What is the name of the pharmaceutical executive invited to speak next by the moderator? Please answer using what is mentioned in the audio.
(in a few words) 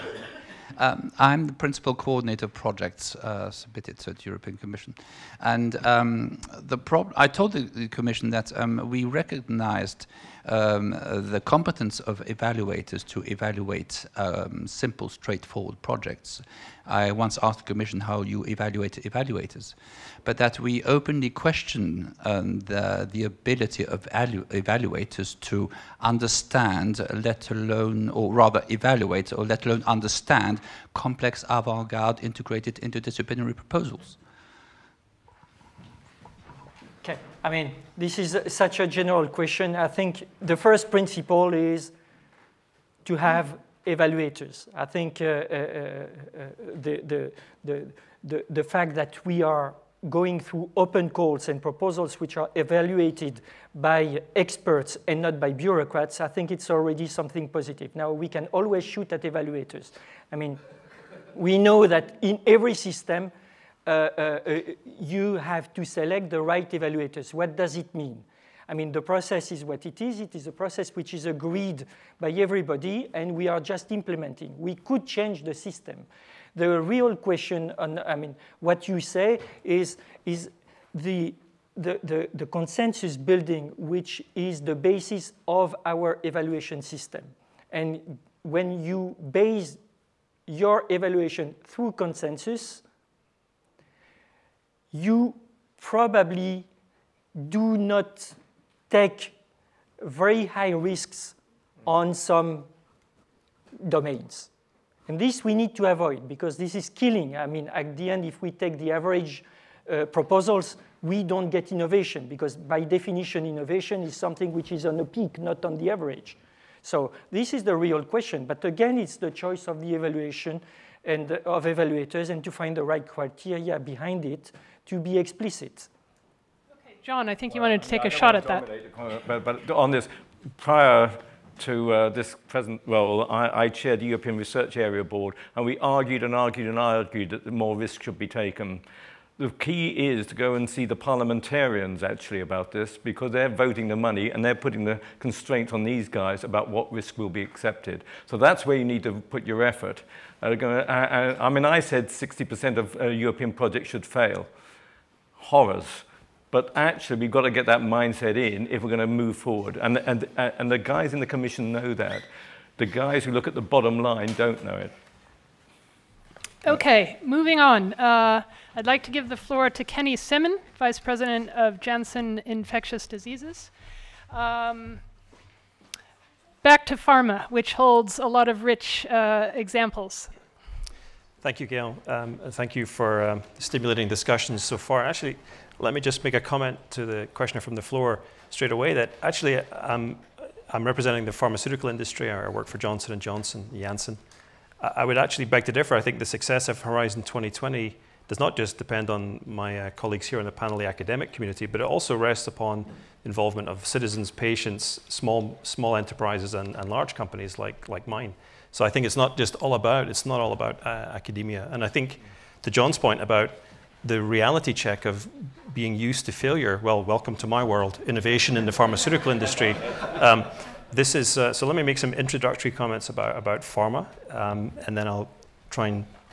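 Kenny Simmen.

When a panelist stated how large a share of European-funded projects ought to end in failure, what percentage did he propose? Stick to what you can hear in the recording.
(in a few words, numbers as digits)
60%.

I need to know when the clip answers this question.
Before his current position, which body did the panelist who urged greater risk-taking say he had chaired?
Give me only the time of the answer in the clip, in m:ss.
2:14.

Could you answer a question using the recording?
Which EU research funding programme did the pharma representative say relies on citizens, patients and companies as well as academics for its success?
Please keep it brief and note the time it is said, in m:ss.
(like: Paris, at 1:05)
Horizon 2020, at 3:16.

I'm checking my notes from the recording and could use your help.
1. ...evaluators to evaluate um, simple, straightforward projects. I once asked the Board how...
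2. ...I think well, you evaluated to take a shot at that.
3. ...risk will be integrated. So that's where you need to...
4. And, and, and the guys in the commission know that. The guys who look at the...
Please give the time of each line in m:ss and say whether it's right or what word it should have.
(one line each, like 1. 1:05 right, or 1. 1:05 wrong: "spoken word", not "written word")
1. 0:12 wrong: "Commission", not "Board"
2. 2:07 wrong: "wanted", not "evaluated"
3. 2:26 wrong: "accepted", not "integrated"
4. 2:39 right.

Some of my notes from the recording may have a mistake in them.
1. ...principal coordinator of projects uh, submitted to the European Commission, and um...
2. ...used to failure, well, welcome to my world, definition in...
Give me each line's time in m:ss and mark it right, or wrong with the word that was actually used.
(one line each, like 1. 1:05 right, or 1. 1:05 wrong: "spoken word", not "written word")
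1. 0:01 right
2. 3:35 wrong: "innovation", not "definition".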